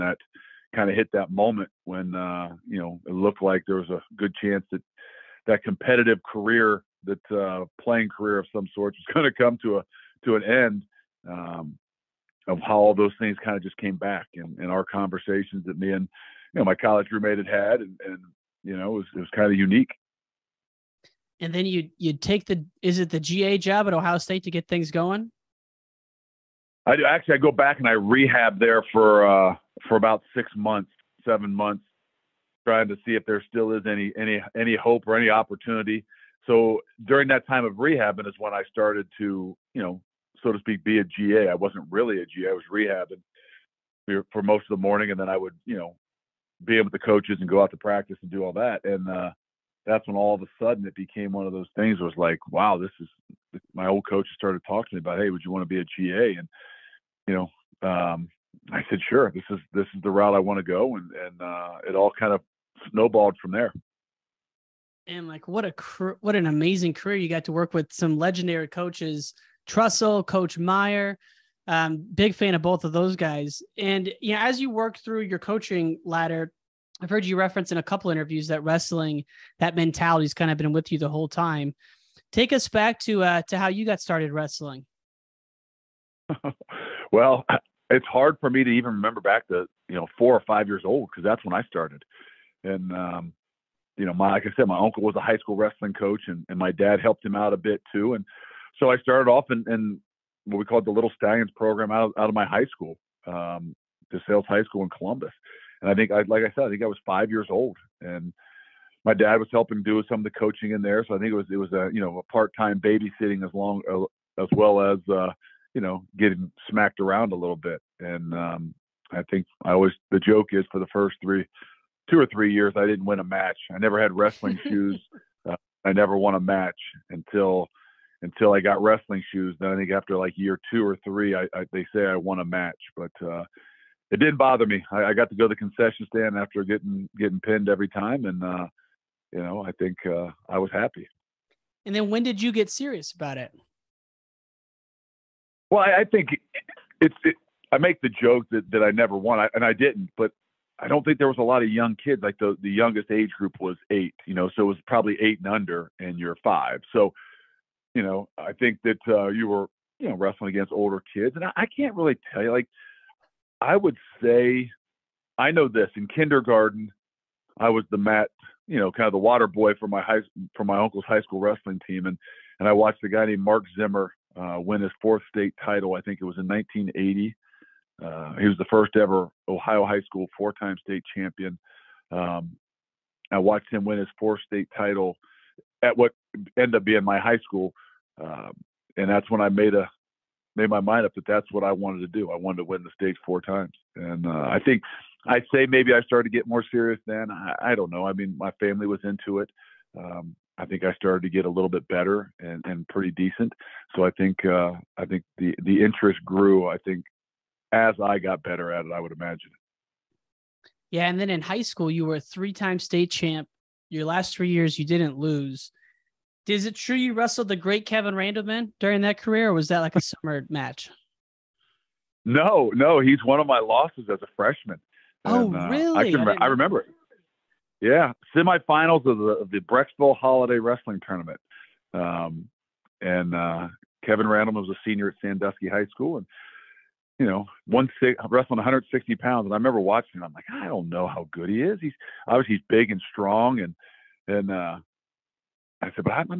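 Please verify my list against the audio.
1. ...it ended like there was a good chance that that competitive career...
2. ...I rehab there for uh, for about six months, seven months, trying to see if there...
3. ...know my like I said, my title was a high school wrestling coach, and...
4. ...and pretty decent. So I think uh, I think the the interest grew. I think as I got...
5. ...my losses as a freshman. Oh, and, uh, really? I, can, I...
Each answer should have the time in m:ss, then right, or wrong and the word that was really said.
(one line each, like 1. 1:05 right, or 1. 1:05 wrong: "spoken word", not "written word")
1. 0:03 wrong: "looked", not "ended"
2. 0:27 right
3. 1:34 wrong: "uncle", not "title"
4. 3:22 right
5. 3:43 right.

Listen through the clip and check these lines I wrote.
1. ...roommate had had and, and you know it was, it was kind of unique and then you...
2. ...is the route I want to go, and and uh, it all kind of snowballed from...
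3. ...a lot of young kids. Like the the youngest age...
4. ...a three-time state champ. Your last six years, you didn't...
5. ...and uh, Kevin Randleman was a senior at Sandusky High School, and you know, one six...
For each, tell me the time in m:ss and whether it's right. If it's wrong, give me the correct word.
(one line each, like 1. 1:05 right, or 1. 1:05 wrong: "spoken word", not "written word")
1. 0:17 right
2. 0:59 right
3. 2:31 right
4. 3:32 wrong: "three", not "six"
5. 3:53 right.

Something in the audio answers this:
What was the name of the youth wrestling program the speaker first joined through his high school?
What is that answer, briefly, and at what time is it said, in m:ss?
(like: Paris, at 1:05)
Little Stallions, at 1:40.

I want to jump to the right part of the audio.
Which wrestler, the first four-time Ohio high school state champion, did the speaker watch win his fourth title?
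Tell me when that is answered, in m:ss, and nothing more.
2:53.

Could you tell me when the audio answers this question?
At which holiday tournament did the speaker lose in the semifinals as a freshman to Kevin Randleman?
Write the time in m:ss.
3:49.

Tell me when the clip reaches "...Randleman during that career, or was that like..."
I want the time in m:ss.
3:38.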